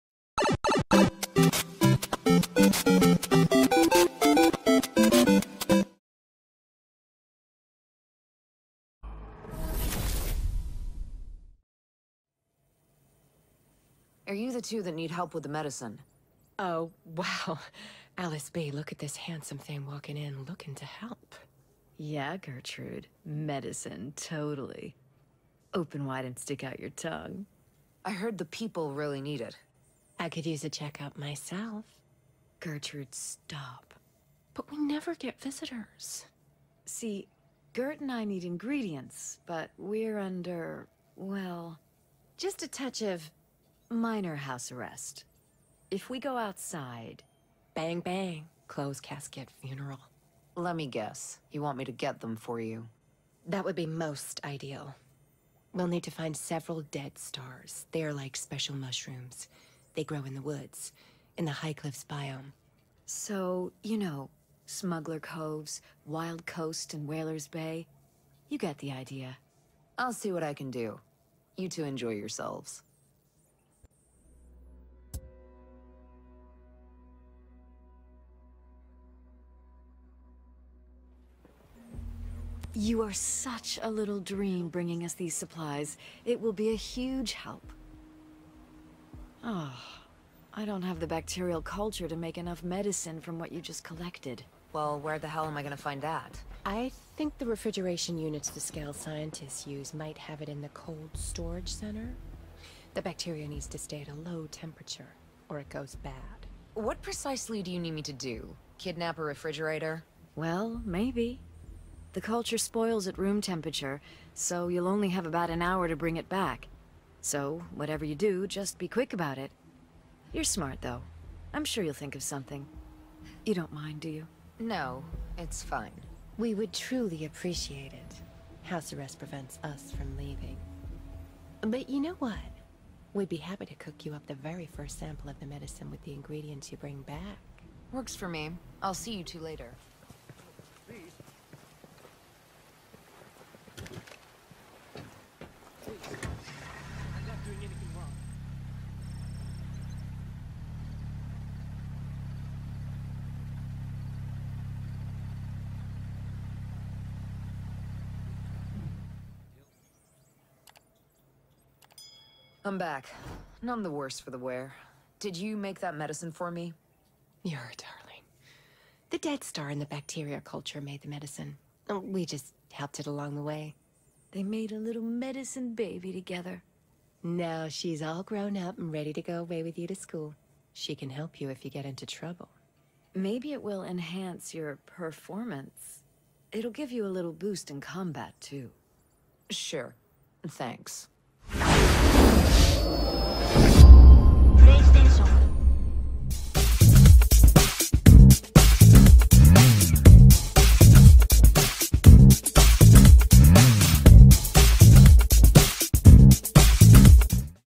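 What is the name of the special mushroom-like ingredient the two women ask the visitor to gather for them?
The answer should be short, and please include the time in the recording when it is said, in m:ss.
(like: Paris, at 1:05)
Dead stars, at 0:56.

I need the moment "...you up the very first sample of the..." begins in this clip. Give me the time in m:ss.
2:14.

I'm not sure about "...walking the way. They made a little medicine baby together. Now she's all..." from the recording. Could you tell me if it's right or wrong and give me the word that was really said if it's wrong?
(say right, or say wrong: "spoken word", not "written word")
wrong: "along", not "walking".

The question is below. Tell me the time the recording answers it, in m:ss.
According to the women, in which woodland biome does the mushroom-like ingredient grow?
1:01.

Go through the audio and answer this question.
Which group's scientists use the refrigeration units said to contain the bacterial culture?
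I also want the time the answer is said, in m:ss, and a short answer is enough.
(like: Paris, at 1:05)
Skell, at 1:38.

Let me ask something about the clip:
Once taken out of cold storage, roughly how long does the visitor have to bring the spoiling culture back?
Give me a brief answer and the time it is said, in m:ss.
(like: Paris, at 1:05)
About an hour, at 1:55.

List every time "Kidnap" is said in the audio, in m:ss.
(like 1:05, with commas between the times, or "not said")
1:48.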